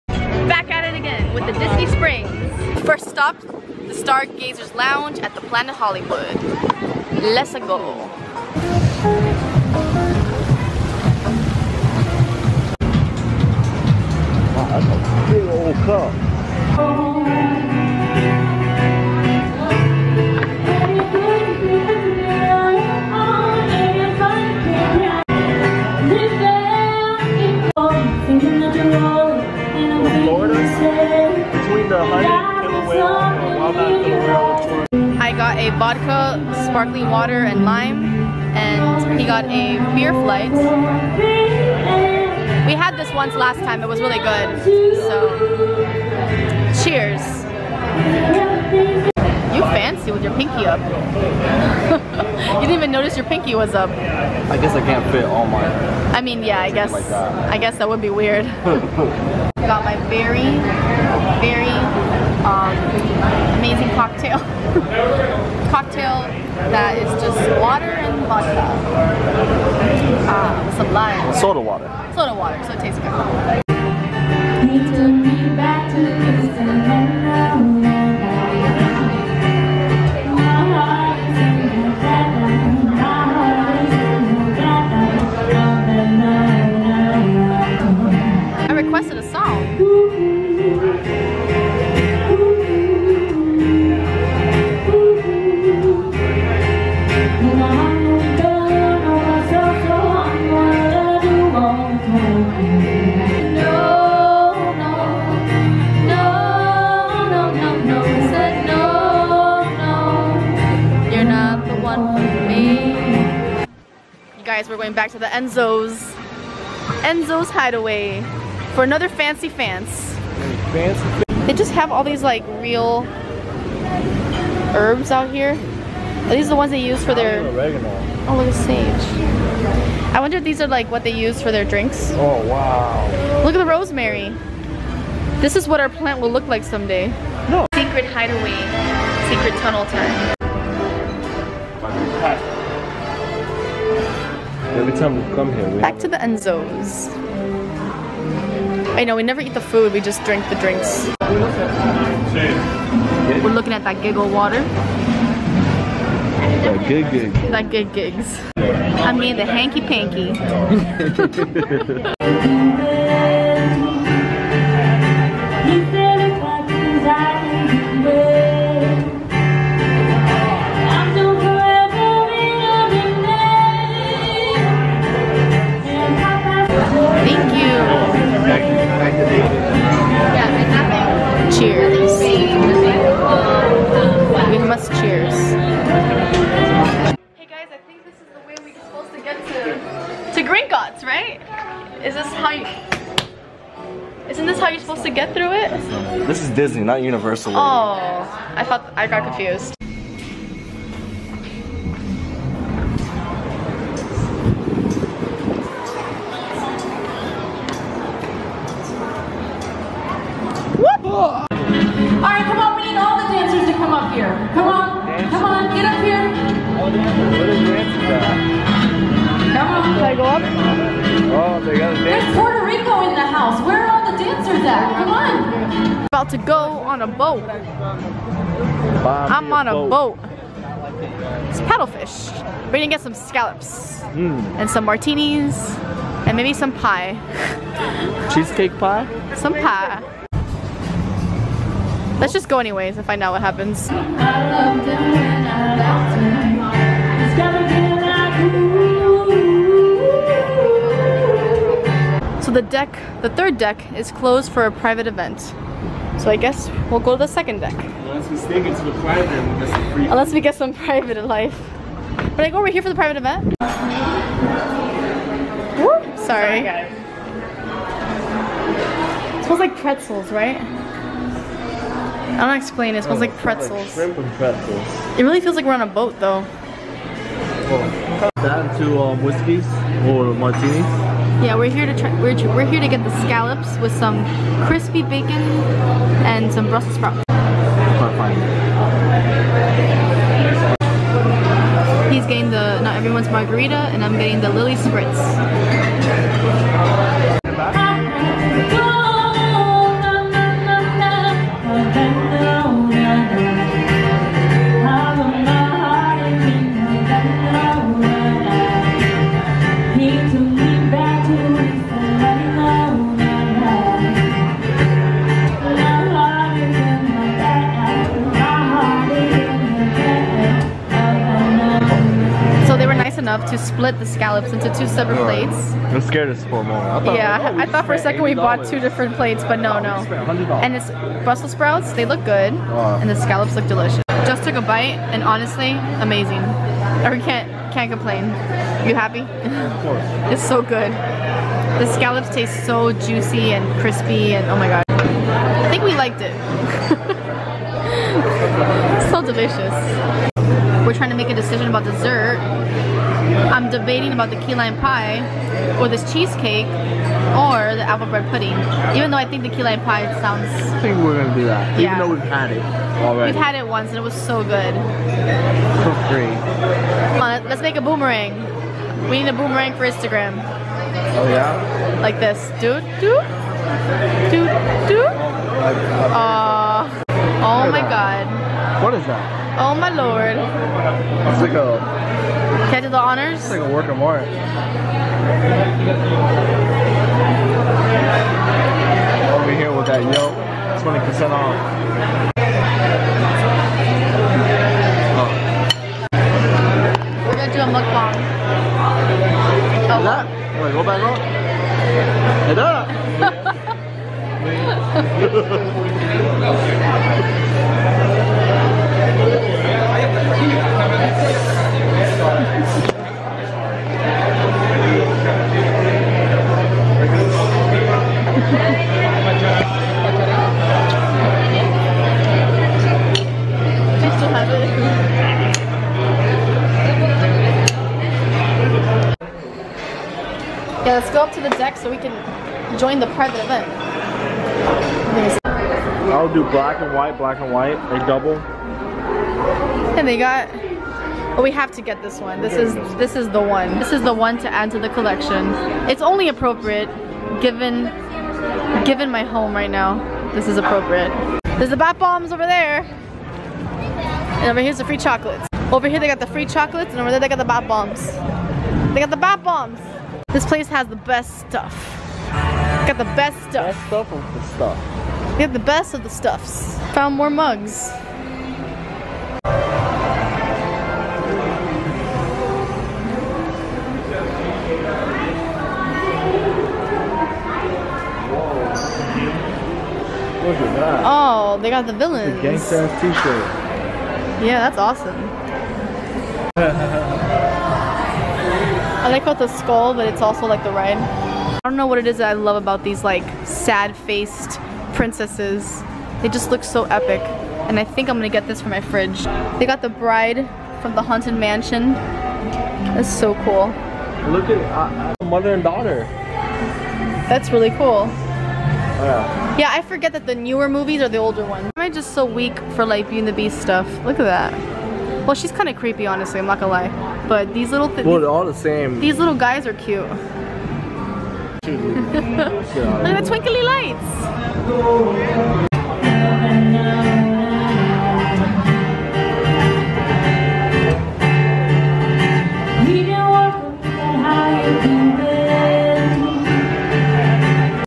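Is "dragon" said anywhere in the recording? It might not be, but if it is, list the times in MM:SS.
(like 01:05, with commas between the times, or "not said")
not said.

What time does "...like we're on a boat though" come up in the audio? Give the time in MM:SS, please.
04:35.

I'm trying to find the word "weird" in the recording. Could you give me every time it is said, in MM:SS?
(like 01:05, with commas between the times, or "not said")
00:58.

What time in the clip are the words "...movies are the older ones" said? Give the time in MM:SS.
08:30.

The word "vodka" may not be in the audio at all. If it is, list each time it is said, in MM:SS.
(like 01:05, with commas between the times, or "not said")
00:35, 01:08.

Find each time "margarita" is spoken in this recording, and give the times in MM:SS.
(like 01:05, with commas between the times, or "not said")
04:53.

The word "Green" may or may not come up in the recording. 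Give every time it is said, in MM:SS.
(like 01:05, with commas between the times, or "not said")
03:10.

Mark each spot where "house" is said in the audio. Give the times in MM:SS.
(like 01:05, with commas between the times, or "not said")
03:43.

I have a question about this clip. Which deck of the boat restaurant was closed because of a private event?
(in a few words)
the third deck.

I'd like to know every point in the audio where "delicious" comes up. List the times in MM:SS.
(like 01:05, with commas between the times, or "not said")
05:33, 05:49.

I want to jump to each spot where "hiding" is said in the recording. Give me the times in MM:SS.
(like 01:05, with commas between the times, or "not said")
not said.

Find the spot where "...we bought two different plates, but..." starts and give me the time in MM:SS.
05:28.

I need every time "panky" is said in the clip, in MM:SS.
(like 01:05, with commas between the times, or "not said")
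02:39.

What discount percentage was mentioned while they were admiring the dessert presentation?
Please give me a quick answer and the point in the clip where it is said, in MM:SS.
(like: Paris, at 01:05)
20%, at 06:30.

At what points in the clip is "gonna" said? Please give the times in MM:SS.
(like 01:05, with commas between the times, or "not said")
03:52, 06:01, 08:18, 08:36.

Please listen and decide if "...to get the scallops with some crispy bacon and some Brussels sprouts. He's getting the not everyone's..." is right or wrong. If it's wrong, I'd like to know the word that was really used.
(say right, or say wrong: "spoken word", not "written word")
right.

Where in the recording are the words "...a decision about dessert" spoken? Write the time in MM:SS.
05:51.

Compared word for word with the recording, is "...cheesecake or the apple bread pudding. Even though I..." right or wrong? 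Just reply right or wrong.
right.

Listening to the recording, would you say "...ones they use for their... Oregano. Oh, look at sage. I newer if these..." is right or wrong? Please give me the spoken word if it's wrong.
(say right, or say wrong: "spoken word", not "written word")
wrong: "wonder", not "newer".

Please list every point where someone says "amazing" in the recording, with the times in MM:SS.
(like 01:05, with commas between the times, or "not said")
01:03, 05:36.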